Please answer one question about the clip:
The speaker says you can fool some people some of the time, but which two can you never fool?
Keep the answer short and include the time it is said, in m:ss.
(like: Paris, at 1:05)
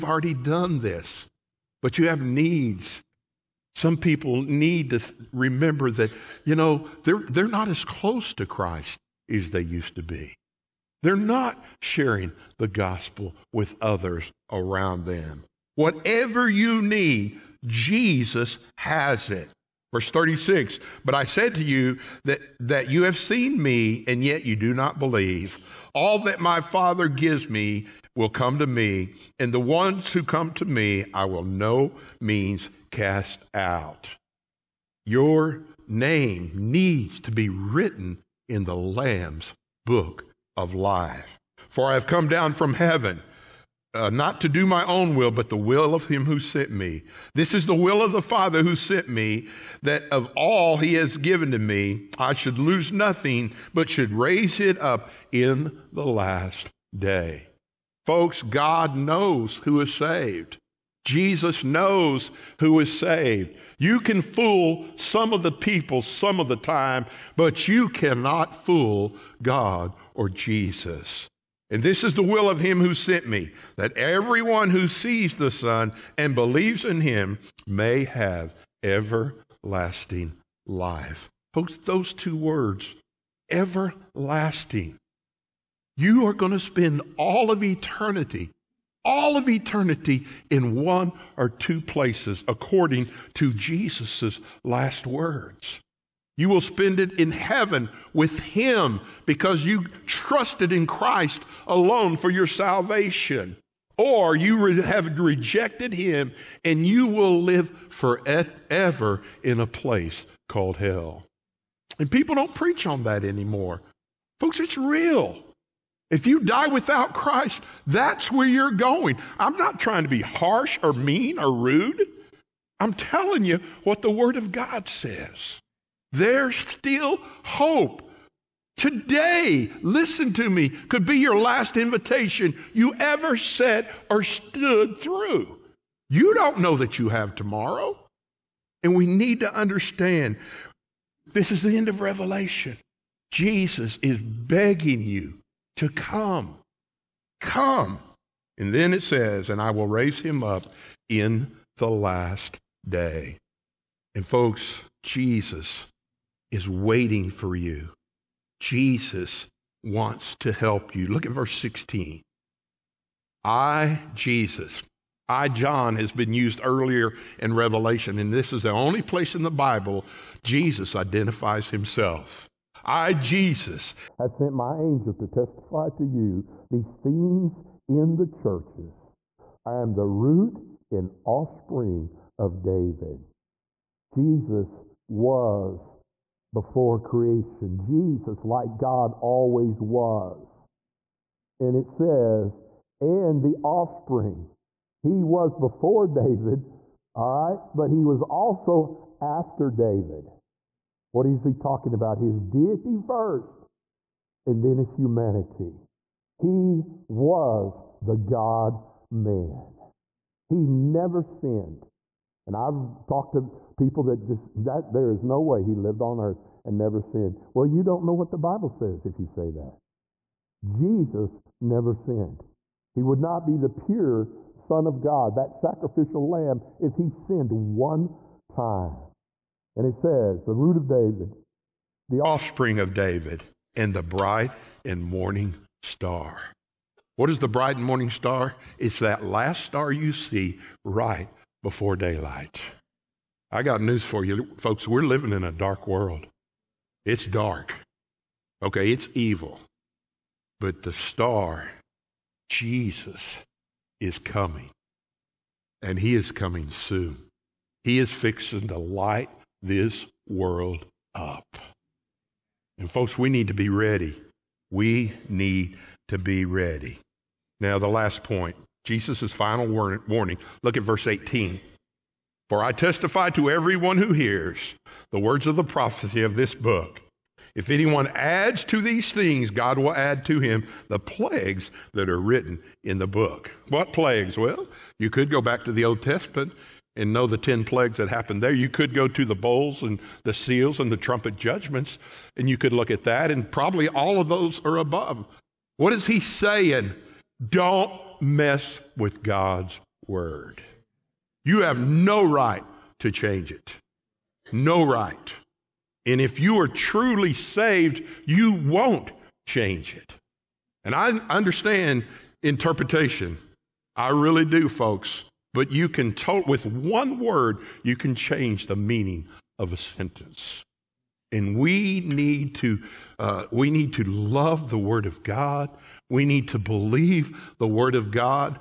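God or Jesus, at 1:09.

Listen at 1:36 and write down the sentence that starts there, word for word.
You will spend it in heaven with Him because you trusted in Christ alone for your salvation.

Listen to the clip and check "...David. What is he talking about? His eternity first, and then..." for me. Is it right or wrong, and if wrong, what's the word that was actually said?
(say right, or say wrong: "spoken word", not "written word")
wrong: "deity", not "eternity".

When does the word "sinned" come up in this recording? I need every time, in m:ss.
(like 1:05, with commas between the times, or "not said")
3:31, 3:36, 3:41, 3:47.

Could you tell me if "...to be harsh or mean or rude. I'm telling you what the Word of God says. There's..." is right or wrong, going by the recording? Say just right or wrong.
right.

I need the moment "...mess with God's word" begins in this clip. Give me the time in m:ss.
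4:58.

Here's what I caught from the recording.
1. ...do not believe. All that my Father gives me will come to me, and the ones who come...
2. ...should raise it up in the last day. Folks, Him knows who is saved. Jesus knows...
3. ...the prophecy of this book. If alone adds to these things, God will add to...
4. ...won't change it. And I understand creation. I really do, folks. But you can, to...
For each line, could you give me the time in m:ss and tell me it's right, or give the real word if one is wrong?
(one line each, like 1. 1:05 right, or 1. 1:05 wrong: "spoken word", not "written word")
1. 0:24 right
2. 0:53 wrong: "God", not "Him"
3. 4:35 wrong: "anyone", not "alone"
4. 5:08 wrong: "interpretation", not "creation".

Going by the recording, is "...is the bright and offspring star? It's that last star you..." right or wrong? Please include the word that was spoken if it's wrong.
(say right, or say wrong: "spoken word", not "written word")
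wrong: "morning", not "offspring".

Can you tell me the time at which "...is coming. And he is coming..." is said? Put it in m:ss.
4:13.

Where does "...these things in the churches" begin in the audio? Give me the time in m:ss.
2:56.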